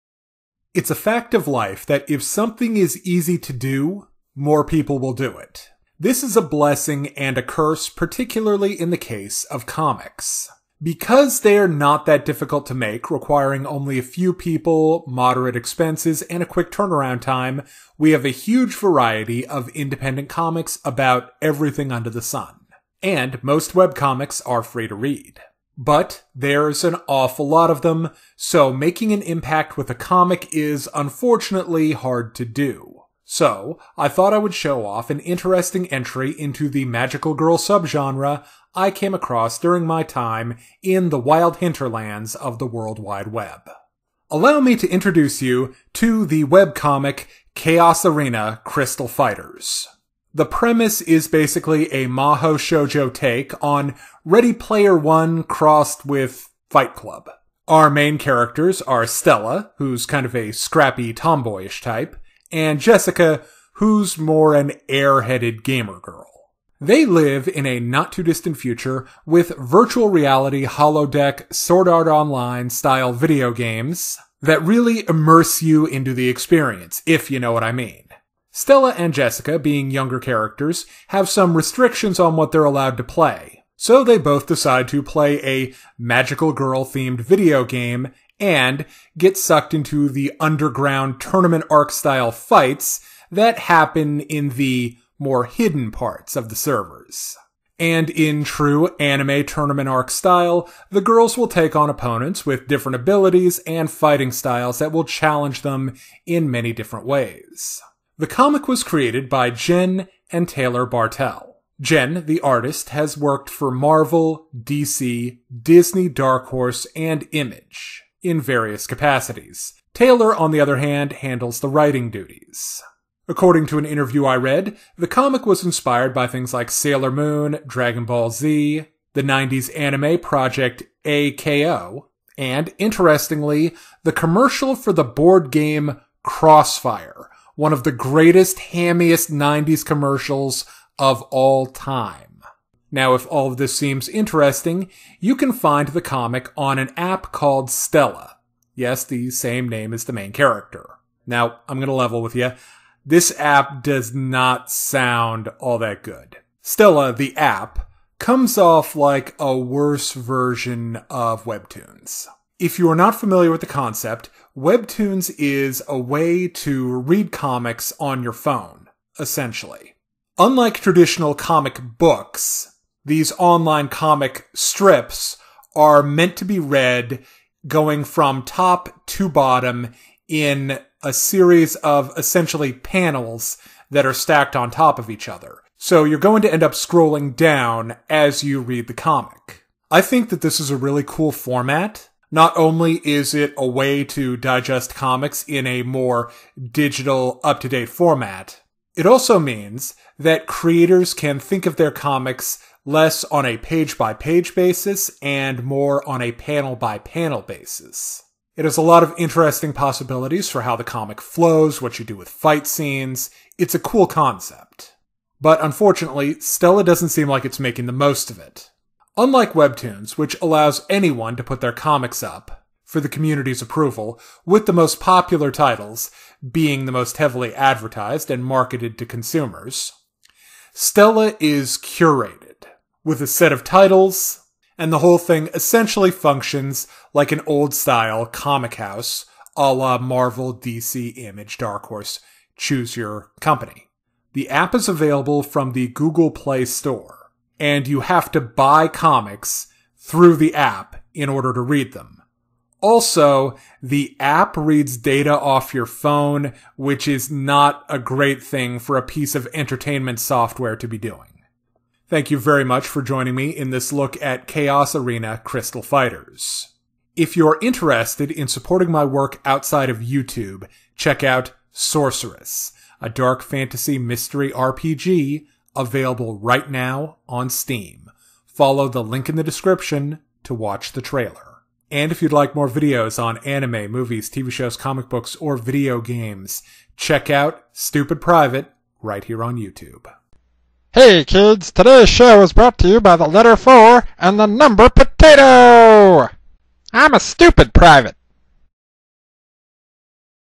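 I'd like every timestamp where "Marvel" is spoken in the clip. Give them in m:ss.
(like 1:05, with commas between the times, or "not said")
1:53, 3:59.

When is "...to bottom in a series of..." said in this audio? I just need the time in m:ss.
2:59.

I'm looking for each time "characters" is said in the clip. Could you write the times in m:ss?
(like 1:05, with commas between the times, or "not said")
0:58, 1:20, 2:30.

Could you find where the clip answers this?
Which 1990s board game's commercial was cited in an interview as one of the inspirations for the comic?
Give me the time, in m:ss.
2:16.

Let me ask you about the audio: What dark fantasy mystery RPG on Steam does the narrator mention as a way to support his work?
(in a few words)
Sorcerous.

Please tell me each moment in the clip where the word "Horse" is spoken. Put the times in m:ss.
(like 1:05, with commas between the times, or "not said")
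1:56, 4:01.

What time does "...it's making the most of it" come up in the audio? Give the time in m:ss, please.
3:37.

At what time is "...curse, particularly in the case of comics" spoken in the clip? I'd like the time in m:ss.
0:07.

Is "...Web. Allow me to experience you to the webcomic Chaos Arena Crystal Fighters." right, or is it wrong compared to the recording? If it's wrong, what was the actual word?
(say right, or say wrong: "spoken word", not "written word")
wrong: "introduce", not "experience".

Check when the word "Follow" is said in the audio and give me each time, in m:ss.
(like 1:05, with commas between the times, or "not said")
4:38.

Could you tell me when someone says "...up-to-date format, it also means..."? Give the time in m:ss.
3:17.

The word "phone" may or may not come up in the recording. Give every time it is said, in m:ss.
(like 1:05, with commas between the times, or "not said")
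2:48, 4:15.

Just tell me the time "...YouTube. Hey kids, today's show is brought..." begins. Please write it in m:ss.
4:49.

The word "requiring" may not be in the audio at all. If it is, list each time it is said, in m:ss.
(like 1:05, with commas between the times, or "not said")
0:13.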